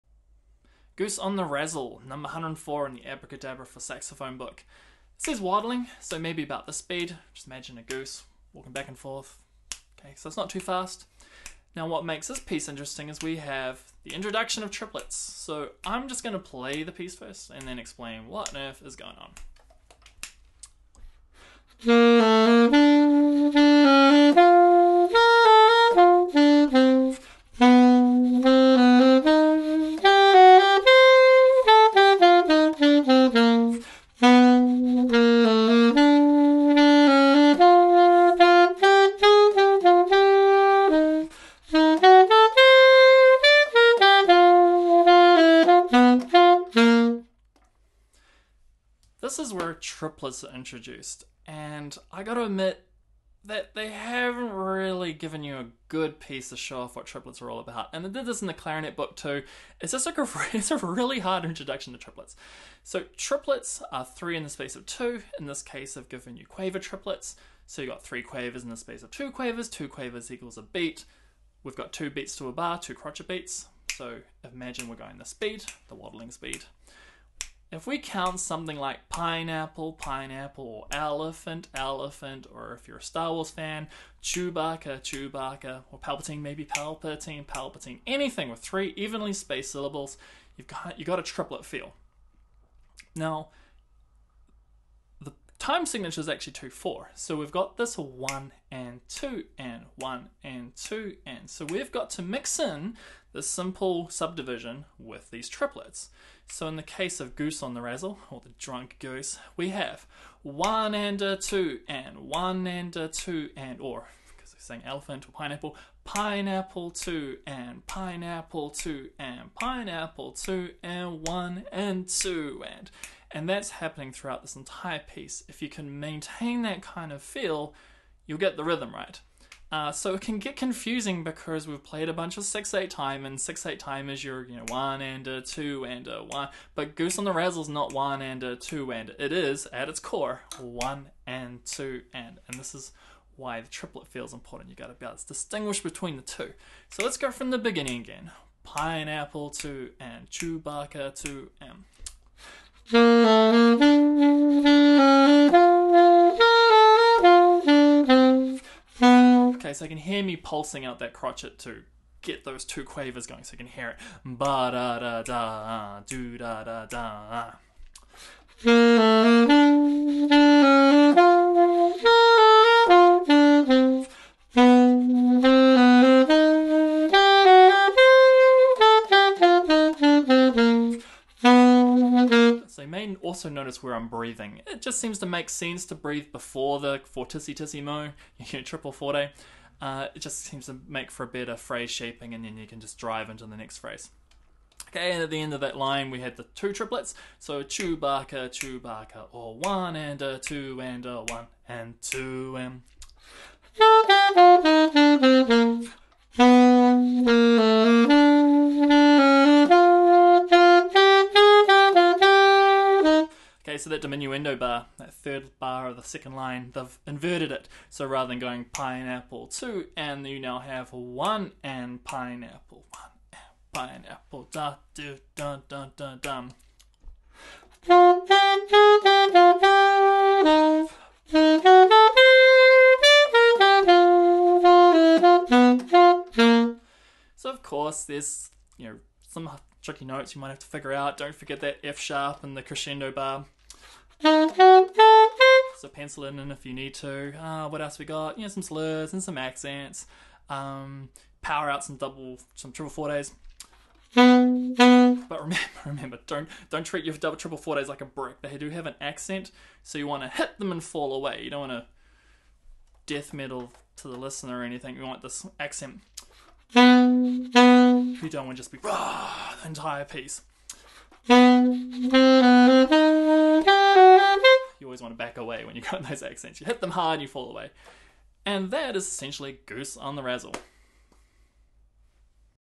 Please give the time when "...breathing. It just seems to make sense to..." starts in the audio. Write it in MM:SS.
03:04.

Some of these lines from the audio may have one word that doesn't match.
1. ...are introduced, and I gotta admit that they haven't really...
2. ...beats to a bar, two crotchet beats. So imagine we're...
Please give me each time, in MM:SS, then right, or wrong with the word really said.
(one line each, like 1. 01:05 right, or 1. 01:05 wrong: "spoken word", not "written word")
1. 00:50 right
2. 01:12 right.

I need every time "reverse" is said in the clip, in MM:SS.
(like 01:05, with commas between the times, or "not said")
not said.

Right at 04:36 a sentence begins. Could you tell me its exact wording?
You hit them hard, you fall away.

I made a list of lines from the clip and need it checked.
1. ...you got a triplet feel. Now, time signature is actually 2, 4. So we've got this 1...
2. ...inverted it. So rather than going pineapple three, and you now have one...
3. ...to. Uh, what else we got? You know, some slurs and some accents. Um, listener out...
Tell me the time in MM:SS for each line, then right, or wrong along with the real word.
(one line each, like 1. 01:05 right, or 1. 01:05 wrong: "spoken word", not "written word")
1. 01:30 right
2. 03:37 wrong: "two", not "three"
3. 04:06 wrong: "power", not "listener".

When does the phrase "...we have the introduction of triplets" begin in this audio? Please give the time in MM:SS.
00:13.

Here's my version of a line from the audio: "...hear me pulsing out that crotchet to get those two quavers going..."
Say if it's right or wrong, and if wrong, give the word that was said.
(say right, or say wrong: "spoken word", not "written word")
right.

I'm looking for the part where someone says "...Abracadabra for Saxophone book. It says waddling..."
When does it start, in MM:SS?
00:03.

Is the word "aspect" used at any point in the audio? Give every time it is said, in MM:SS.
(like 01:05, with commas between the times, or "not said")
not said.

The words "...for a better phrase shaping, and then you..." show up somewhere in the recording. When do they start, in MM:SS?
03:11.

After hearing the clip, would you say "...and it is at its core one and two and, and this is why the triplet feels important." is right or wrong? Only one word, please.
right.